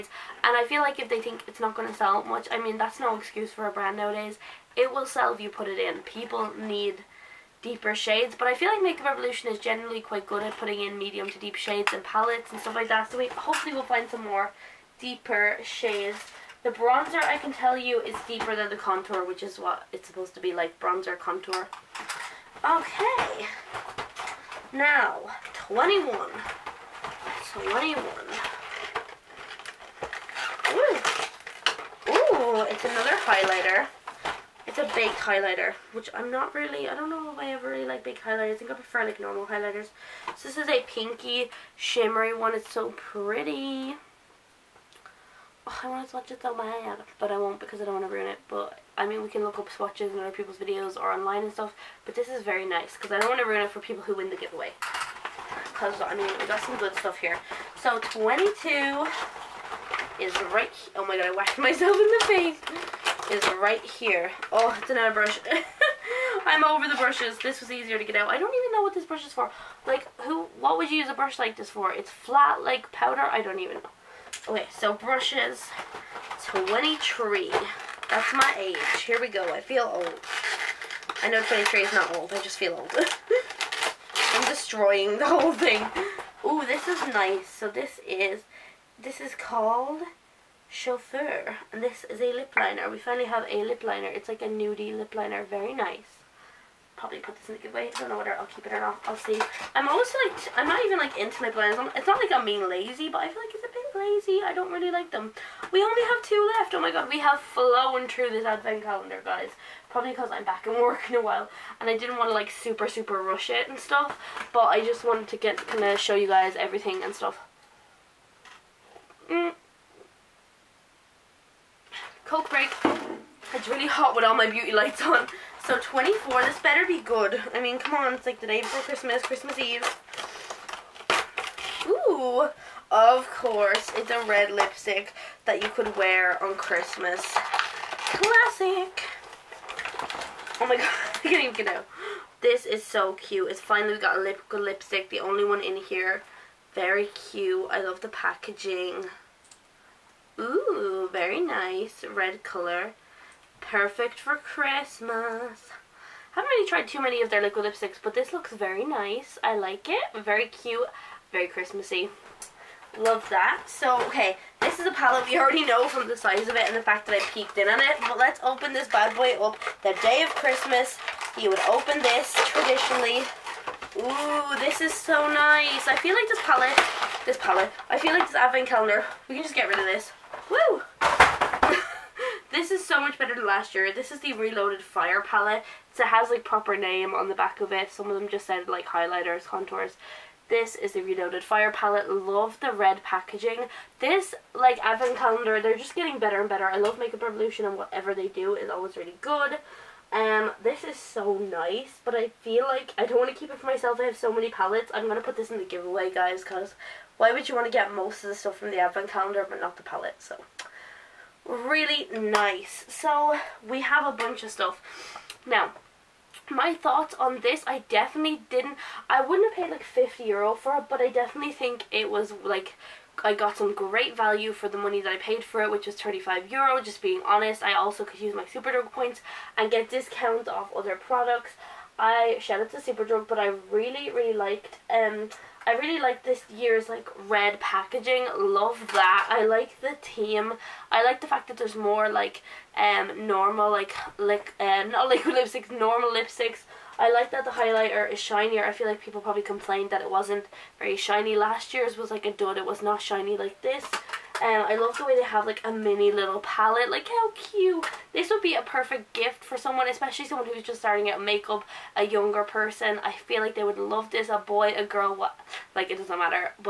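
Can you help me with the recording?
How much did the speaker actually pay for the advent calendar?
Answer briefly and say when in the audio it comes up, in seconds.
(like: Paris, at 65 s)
35 euro, at 225 s.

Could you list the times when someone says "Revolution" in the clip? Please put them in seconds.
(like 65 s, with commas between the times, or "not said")
9 s, 197 s.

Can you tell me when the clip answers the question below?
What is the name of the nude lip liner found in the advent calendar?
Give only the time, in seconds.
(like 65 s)
90 s.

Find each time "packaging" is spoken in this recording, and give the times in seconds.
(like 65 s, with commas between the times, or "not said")
148 s, 193 s, 237 s.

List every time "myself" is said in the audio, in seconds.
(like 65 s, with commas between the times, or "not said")
61 s, 203 s.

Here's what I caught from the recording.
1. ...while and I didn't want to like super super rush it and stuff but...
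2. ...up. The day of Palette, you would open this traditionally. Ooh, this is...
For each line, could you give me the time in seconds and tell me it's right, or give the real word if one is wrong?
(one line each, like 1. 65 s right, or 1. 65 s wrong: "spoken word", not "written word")
1. 111 s right
2. 169 s wrong: "Christmas", not "Palette".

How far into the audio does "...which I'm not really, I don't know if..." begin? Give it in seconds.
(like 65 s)
35 s.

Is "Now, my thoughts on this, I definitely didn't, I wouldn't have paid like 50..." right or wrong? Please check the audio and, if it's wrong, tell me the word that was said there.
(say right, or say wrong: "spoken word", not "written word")
right.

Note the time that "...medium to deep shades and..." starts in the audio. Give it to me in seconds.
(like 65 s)
10 s.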